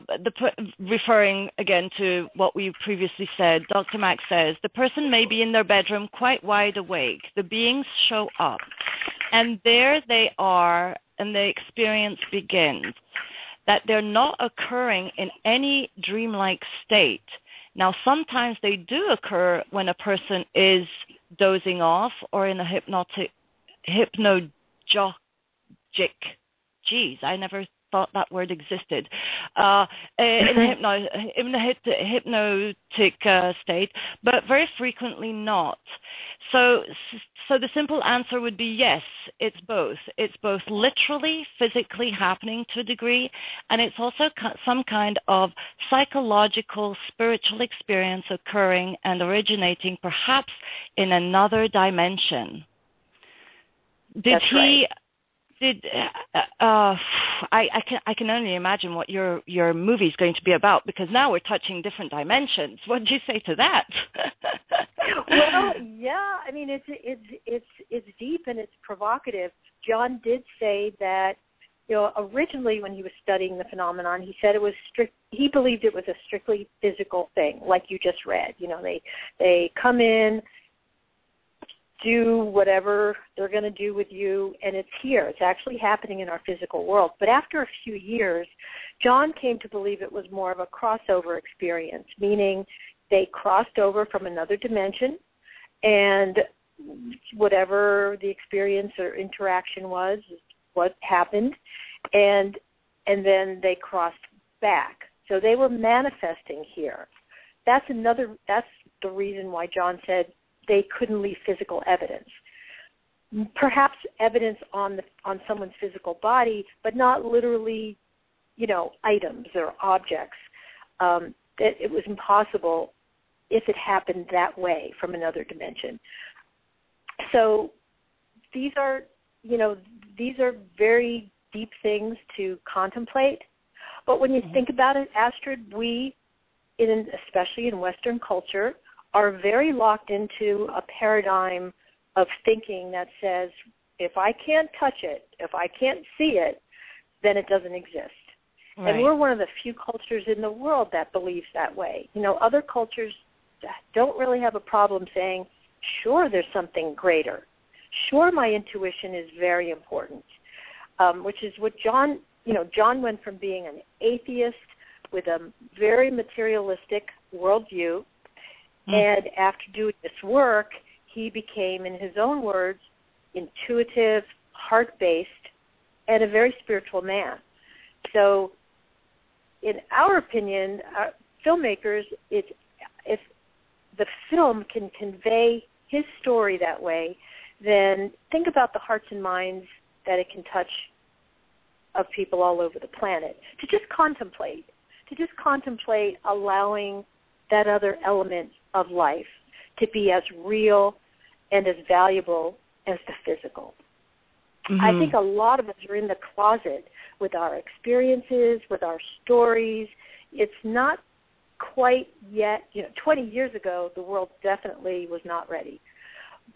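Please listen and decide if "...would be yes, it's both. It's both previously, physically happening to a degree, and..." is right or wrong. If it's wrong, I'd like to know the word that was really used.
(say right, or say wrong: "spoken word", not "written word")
wrong: "literally", not "previously".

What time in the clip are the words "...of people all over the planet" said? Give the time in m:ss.
3:11.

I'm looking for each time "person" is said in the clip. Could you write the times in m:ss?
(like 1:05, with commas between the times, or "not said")
0:04, 0:19.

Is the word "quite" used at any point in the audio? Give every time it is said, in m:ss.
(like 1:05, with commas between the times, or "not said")
0:06, 3:31.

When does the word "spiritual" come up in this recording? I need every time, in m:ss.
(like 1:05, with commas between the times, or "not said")
0:47, 2:56.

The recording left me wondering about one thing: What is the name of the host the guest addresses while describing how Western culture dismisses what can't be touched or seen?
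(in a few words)
Astrid.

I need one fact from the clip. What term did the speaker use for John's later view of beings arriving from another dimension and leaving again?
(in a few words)
crossover experience.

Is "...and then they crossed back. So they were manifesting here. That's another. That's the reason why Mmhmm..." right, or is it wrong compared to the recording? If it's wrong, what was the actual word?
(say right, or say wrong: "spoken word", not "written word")
wrong: "John", not "Mmhmm".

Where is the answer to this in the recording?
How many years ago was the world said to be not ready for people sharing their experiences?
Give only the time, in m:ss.
3:33.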